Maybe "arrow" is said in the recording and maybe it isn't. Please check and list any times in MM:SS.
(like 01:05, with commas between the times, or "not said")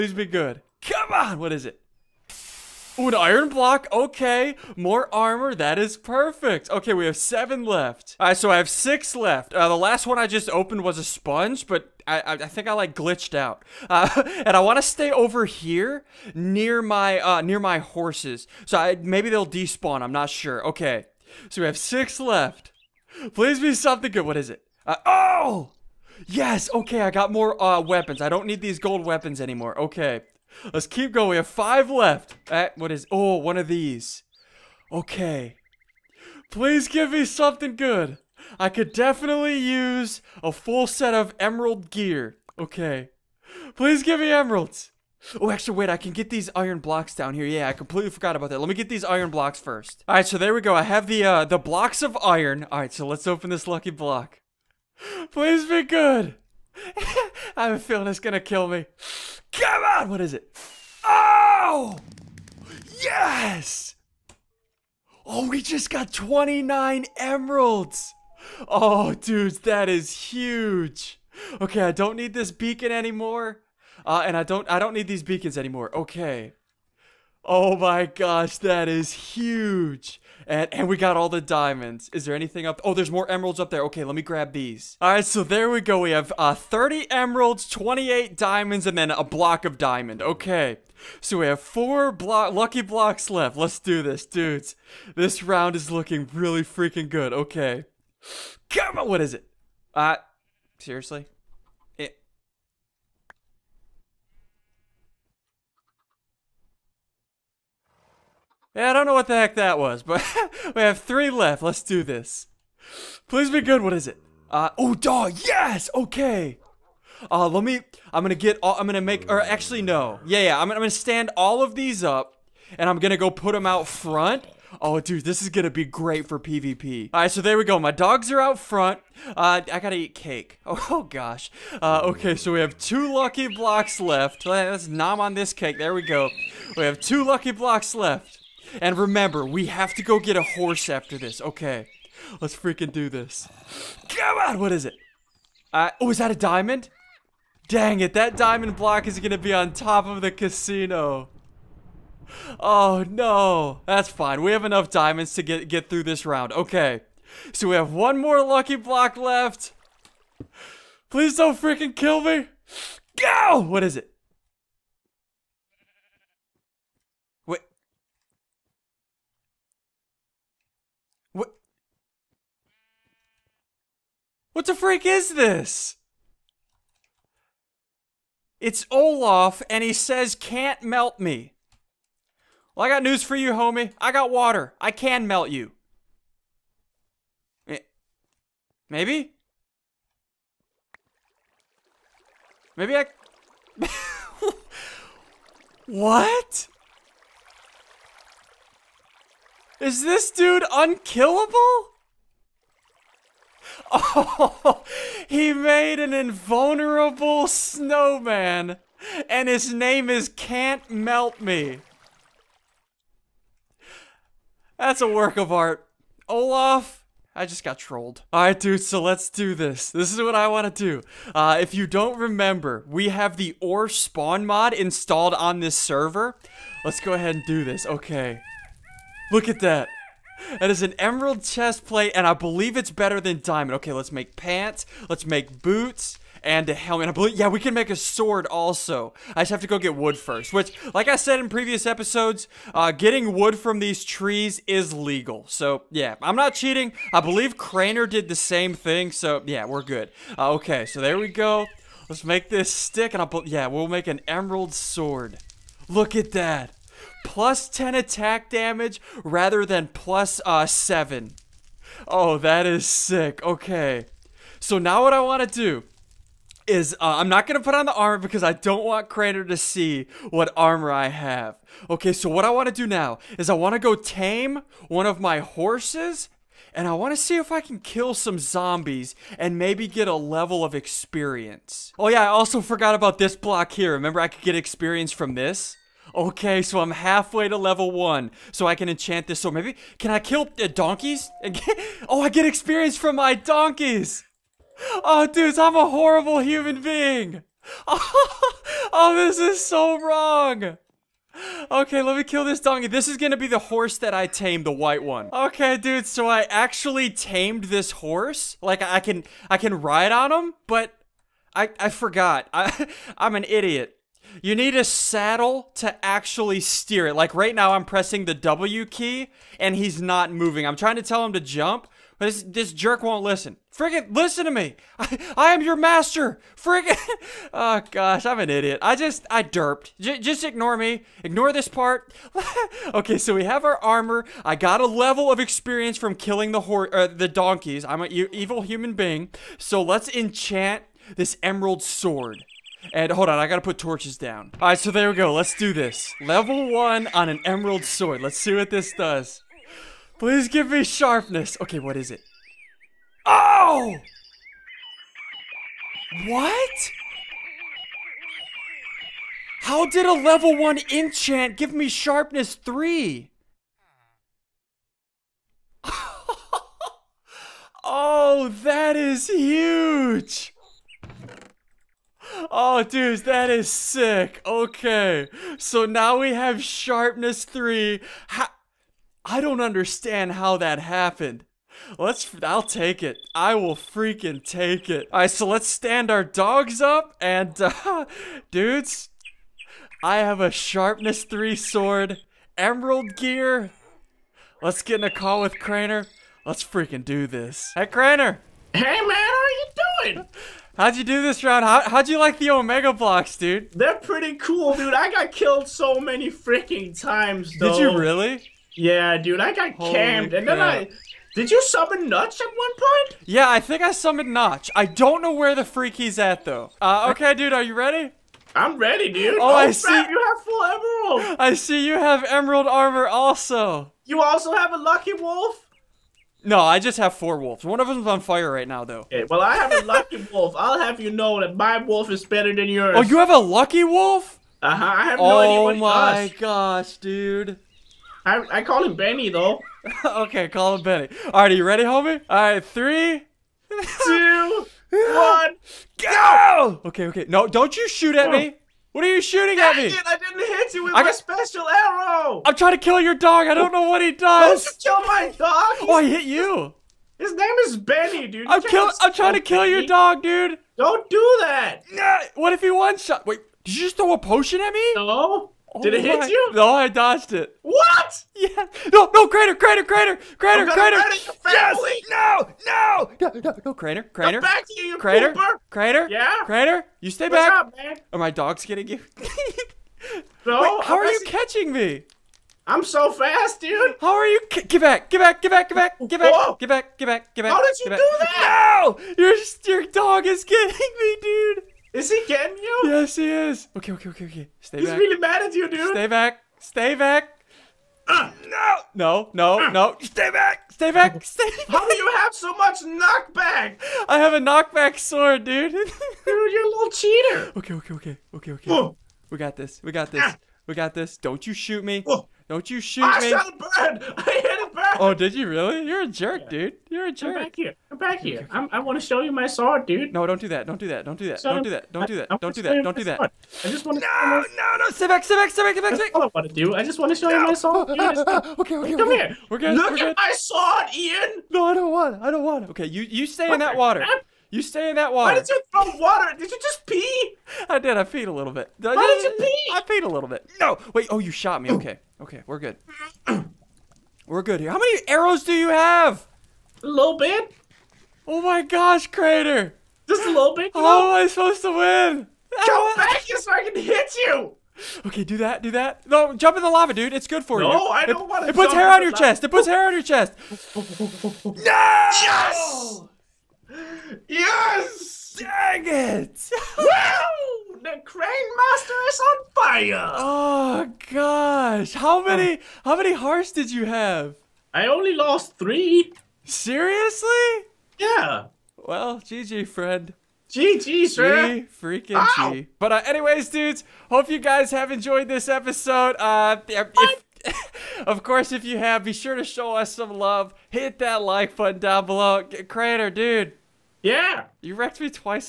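07:31, 09:05.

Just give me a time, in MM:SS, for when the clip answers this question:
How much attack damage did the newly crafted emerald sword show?
04:17.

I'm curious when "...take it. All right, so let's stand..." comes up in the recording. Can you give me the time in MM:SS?
06:24.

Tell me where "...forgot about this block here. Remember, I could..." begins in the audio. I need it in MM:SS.
04:42.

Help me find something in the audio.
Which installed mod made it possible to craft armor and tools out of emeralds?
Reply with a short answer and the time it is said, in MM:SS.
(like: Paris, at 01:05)
OreSpawn, at 03:43.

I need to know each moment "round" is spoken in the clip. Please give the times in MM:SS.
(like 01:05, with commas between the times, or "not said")
01:35, 02:36, 06:41.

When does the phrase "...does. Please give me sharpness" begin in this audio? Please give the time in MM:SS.
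05:48.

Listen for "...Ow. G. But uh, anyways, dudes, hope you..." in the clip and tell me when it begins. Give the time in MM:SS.
09:42.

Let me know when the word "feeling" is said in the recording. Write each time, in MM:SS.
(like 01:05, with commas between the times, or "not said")
00:57.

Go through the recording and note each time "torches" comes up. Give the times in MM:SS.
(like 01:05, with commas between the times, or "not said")
05:43.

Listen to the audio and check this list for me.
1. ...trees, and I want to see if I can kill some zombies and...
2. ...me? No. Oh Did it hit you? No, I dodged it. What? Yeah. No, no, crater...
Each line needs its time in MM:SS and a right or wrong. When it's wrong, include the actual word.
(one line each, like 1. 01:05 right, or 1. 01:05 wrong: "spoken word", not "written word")
1. 04:35 wrong: "horses", not "trees"
2. 07:44 right.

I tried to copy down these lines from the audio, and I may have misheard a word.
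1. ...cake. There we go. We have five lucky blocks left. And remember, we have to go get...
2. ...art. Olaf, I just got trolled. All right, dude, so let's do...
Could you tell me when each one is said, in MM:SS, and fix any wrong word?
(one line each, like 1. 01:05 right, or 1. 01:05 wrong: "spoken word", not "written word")
1. 02:15 wrong: "two", not "five"
2. 03:35 right.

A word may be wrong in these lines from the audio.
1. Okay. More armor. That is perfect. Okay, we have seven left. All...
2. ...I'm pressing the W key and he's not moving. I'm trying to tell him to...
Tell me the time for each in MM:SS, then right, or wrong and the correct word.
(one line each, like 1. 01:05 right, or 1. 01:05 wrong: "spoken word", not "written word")
1. 00:03 right
2. 05:17 right.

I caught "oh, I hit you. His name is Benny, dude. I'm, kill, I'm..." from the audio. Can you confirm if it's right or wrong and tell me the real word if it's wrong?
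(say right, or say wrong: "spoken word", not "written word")
right.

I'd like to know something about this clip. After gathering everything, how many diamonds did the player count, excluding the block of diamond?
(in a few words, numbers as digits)
28.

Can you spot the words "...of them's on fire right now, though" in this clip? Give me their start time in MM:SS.
07:07.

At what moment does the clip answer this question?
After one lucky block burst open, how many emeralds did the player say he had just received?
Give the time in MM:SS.
01:06.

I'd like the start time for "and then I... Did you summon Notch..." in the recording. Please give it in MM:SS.
06:50.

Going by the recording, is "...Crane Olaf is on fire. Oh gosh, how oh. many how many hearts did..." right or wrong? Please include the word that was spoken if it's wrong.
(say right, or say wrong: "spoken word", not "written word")
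wrong: "Master", not "Olaf".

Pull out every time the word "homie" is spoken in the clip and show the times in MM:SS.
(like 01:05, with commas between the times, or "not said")
03:03, 07:21.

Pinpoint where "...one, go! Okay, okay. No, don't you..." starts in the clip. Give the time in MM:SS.
07:24.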